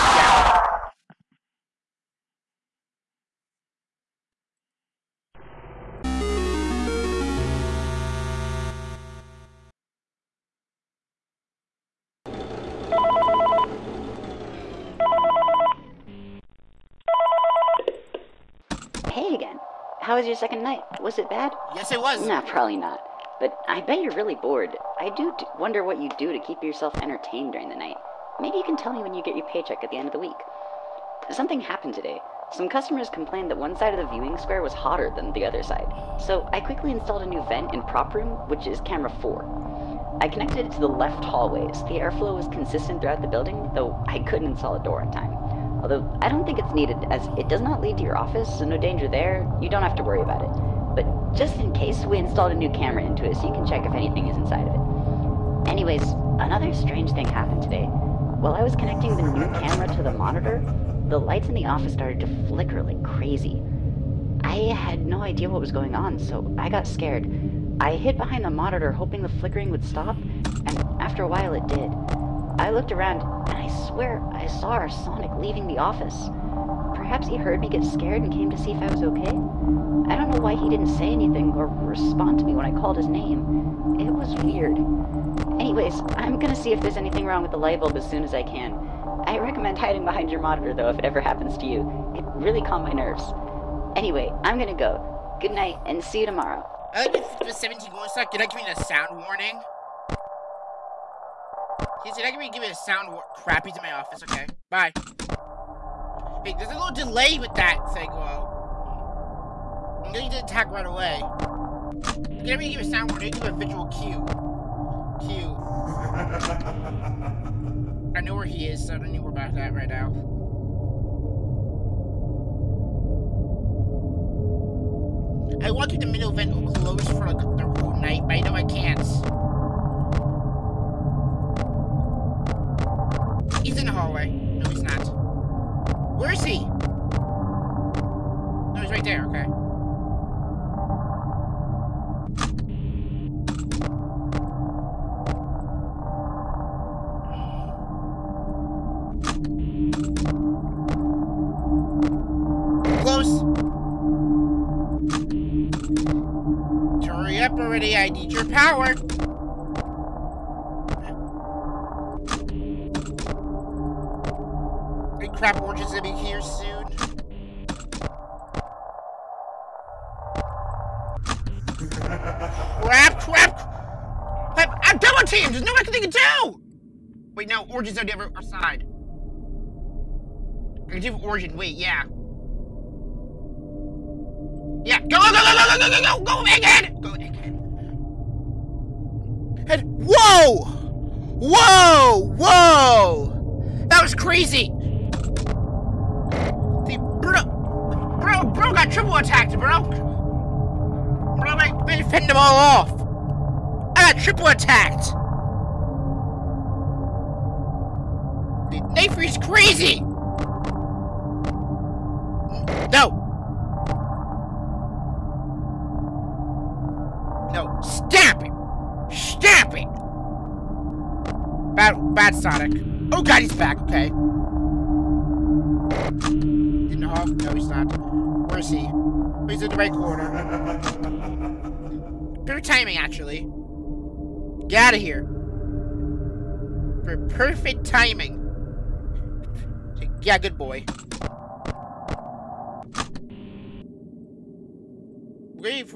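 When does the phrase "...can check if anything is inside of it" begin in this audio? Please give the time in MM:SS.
00:53.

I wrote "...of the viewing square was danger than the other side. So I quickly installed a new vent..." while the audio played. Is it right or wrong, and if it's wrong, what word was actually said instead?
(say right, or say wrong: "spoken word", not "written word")
wrong: "hotter", not "danger".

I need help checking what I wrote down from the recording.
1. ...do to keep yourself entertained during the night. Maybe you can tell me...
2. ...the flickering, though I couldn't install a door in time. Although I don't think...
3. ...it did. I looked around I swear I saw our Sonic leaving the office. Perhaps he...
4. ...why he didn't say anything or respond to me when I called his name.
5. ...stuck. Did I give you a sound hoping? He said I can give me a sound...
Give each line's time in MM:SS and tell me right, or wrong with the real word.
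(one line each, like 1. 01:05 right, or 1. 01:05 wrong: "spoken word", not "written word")
1. 00:26 right
2. 00:43 wrong: "building", not "flickering"
3. 01:11 right
4. 01:20 right
5. 01:38 wrong: "warning", not "hoping".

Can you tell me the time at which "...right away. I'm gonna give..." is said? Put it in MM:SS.
01:50.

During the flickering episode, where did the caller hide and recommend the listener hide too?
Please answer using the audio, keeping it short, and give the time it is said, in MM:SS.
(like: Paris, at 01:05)
Behind the monitor, at 01:08.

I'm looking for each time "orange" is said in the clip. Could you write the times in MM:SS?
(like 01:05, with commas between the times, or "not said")
02:45, 02:57.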